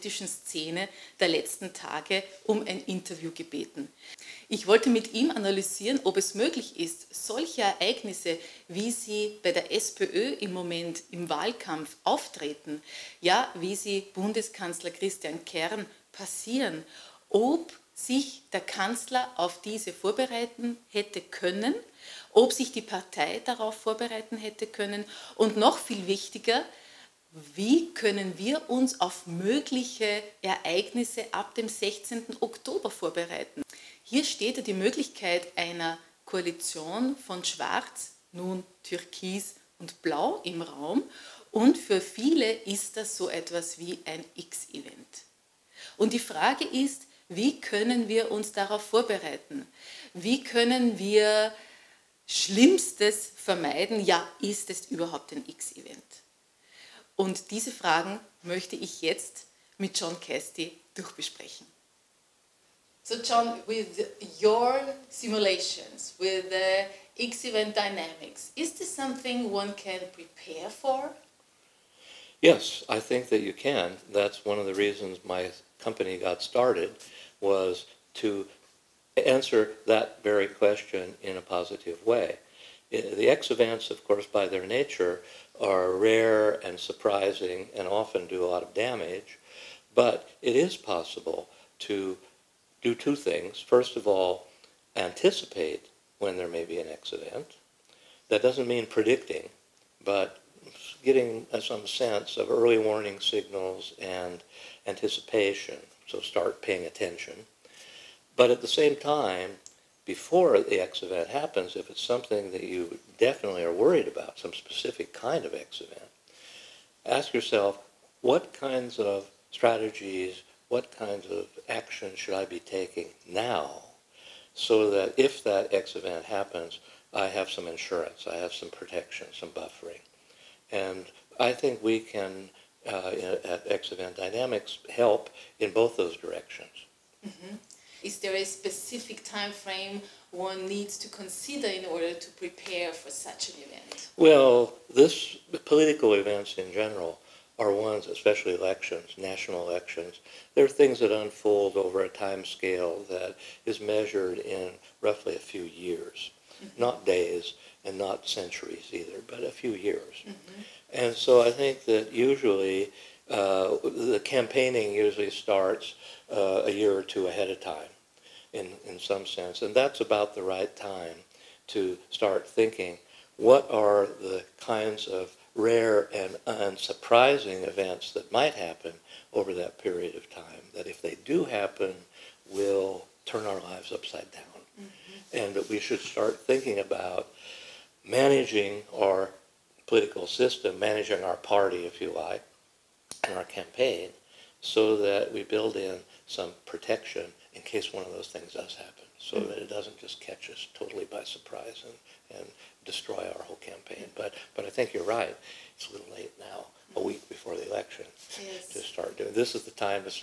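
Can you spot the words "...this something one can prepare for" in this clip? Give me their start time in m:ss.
1:08.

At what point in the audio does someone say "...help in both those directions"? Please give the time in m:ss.
2:14.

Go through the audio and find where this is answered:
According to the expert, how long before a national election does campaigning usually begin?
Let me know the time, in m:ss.
2:46.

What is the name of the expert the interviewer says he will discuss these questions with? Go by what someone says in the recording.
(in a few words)
John Casty.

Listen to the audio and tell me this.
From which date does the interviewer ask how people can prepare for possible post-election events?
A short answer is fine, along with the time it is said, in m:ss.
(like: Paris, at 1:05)
16. Oktober, at 0:31.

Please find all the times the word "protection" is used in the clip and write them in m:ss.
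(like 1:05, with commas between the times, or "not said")
2:08, 3:16.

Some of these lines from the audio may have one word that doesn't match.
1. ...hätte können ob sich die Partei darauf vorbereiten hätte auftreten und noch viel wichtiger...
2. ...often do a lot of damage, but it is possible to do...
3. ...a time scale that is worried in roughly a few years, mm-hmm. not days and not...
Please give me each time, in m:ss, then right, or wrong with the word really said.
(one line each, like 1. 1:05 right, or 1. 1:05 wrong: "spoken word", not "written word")
1. 0:20 wrong: "können", not "auftreten"
2. 1:27 right
3. 2:32 wrong: "measured", not "worried".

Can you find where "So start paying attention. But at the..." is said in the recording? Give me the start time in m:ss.
1:46.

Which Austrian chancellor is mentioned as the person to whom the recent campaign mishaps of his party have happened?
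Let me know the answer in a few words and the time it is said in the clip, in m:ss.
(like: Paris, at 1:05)
Christian Kern, at 0:14.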